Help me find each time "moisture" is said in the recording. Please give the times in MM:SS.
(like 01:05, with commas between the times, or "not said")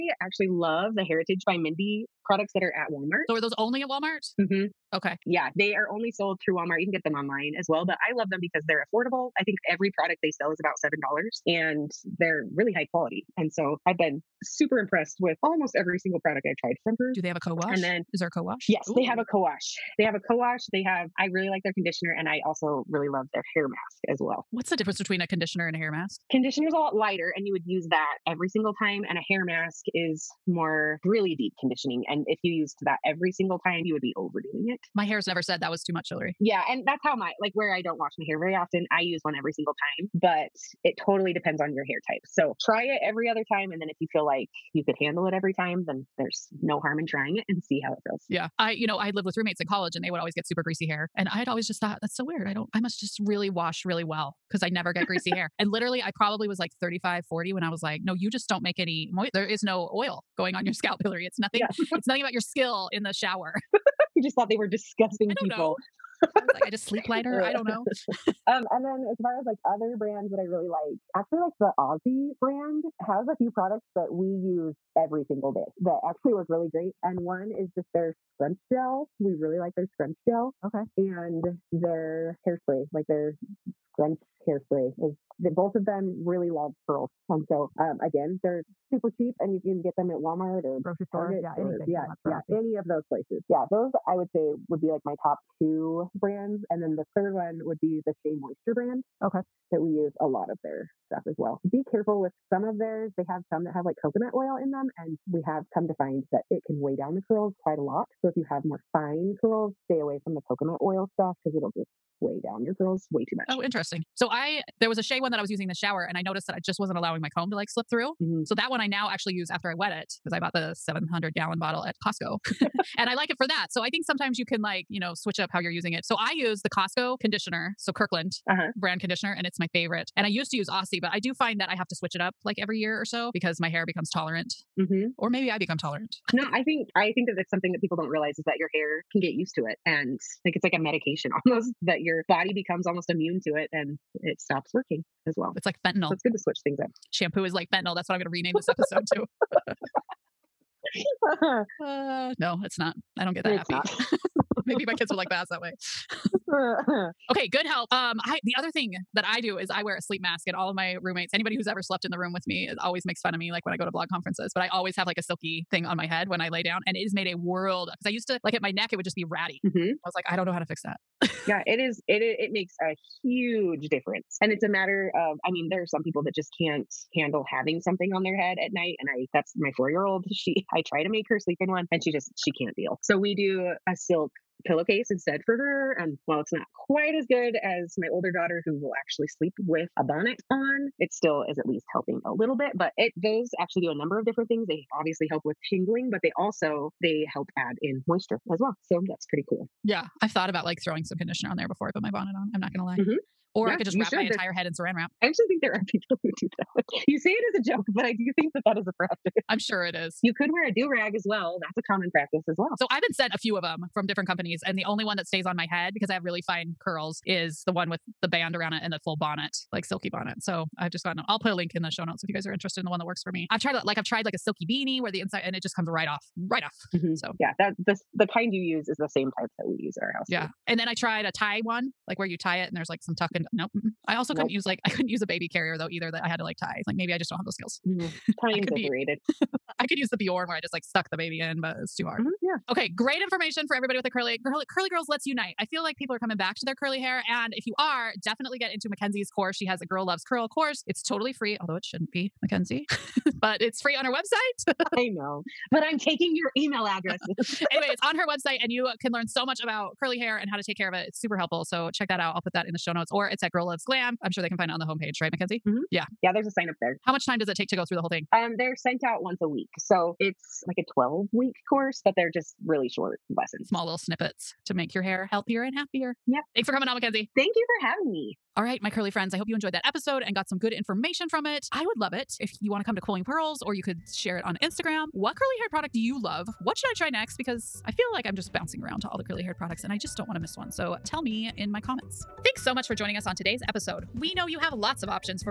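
01:38, 03:18.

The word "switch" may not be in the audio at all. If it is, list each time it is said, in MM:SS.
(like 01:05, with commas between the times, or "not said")
02:05, 02:11, 02:26.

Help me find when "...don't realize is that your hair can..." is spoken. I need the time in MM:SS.
02:17.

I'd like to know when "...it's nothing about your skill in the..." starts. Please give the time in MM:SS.
01:01.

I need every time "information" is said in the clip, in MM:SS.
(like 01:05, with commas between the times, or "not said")
04:03, 04:40.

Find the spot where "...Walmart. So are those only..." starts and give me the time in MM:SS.
00:02.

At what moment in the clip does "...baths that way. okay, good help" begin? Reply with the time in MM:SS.
02:35.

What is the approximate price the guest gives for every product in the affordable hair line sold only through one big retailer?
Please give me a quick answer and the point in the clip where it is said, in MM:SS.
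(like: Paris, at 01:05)
$7, at 00:10.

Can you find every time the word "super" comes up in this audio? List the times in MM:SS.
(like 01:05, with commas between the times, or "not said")
00:14, 00:50, 01:28, 04:21.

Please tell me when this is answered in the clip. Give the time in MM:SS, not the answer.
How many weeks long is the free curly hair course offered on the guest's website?
04:30.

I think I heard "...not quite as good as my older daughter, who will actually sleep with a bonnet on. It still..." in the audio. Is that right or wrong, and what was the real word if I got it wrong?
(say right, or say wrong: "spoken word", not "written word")
right.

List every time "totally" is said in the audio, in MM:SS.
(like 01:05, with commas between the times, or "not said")
00:41, 04:11.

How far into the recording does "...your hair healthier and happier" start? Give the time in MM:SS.
04:34.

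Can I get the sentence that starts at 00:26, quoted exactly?
Conditioner is a lot lighter and you would use that every single time.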